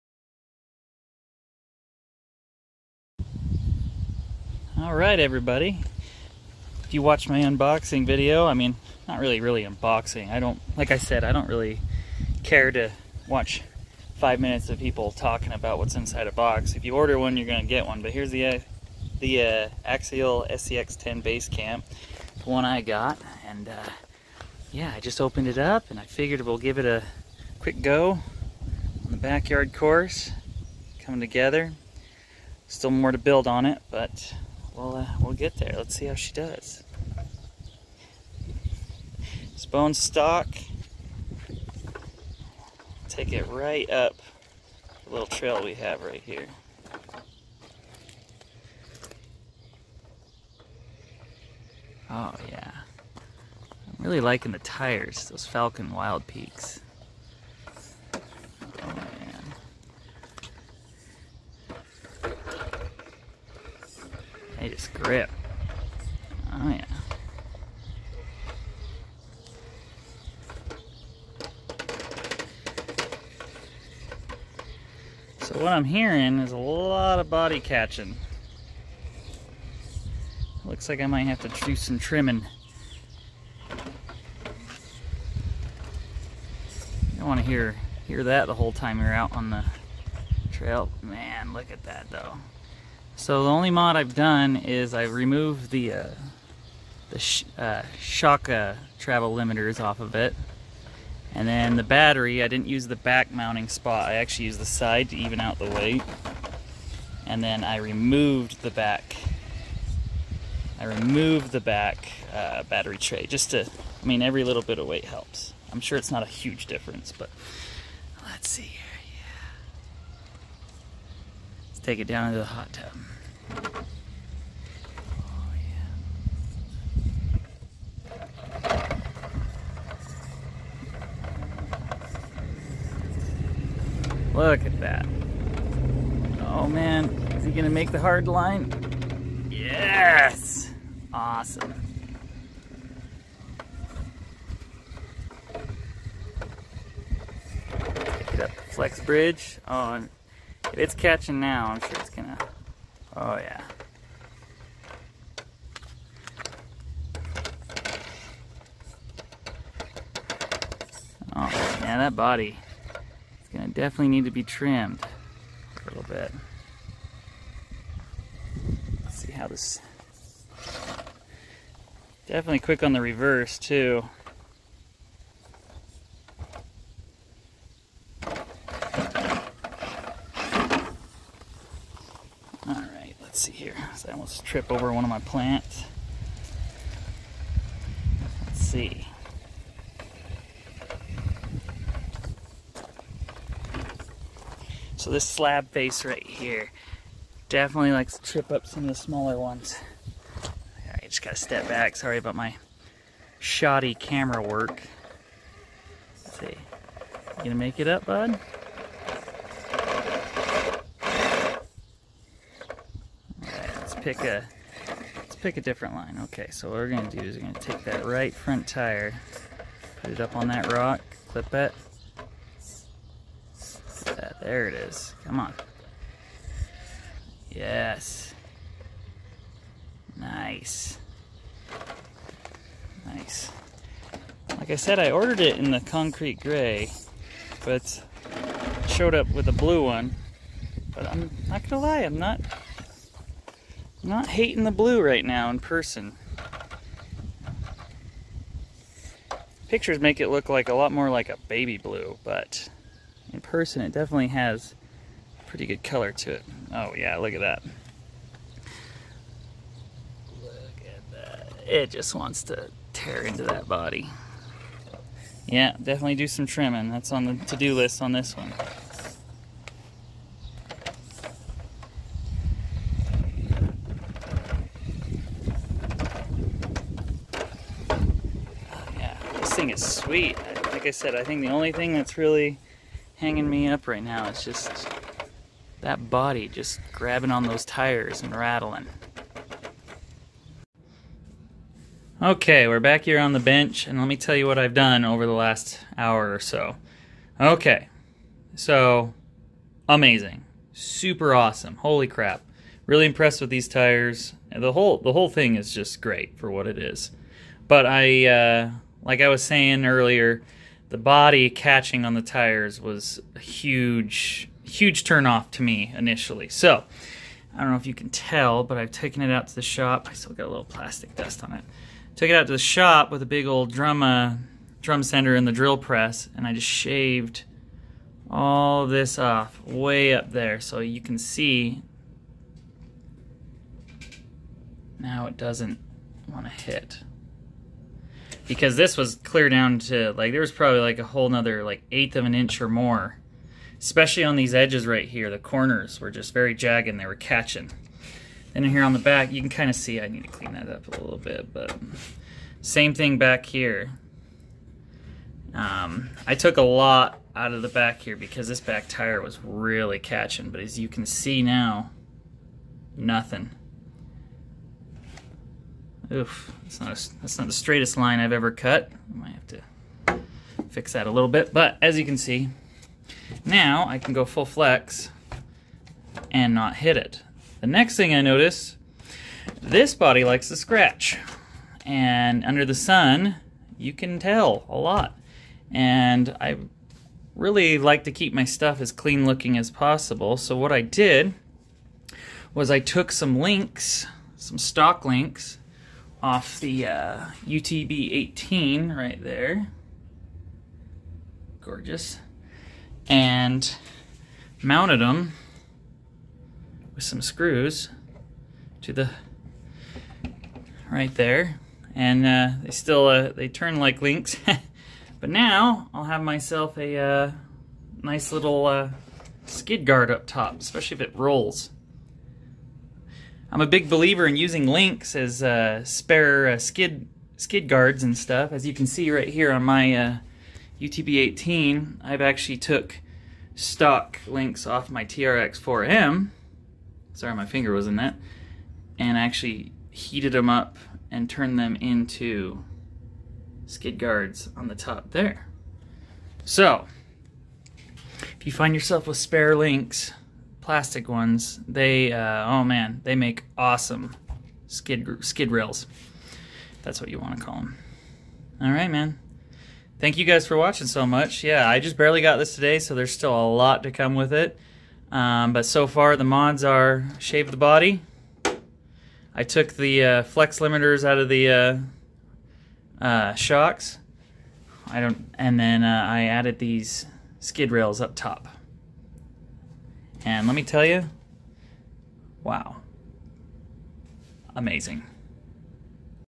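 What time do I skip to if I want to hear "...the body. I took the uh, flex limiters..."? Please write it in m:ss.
7:47.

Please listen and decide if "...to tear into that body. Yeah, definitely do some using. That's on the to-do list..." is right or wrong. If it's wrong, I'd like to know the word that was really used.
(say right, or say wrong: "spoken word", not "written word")
wrong: "trimming", not "using".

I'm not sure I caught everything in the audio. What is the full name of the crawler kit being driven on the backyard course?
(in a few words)
Axial SCX10 Base Camp.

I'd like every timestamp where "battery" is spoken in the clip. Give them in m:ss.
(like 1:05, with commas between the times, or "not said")
1:41, 1:52.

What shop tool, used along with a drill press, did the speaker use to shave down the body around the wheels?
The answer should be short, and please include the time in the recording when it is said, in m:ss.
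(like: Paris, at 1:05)
Drum sander, at 5:24.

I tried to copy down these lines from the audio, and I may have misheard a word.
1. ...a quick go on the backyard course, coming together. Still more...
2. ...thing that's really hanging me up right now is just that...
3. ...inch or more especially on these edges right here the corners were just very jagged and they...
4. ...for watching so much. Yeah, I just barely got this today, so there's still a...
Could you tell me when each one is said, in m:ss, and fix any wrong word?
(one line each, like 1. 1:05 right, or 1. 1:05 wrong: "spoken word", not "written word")
1. 0:26 right
2. 4:41 right
3. 5:42 right
4. 7:40 right.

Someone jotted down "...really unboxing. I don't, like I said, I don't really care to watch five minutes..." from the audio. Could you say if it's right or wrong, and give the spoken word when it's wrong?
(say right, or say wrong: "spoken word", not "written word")
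right.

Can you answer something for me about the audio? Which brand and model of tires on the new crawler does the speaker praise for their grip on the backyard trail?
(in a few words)
Falken Wild Peaks.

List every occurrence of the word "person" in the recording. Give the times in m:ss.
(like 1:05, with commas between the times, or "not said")
4:05, 4:13.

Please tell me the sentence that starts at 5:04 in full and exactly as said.
The whole the whole thing is just great for what it is.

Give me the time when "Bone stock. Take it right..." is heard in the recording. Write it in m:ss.
0:39.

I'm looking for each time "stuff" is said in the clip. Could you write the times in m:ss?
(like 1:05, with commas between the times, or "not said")
6:28, 7:08.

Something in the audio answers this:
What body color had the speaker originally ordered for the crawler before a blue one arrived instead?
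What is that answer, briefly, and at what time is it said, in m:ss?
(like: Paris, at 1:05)
Concrete gray, at 3:55.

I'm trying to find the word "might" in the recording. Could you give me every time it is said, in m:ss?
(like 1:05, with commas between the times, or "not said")
1:21, 6:09.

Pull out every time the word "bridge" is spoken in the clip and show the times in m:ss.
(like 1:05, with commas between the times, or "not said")
2:29.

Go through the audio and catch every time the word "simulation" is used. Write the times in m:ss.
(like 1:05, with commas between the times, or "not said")
not said.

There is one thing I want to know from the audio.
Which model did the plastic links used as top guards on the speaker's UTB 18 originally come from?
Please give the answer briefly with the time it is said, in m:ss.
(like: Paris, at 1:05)
TRX 4M, at 7:15.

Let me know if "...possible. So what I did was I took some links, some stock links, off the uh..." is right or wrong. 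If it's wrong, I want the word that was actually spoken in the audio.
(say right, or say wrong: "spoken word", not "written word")
right.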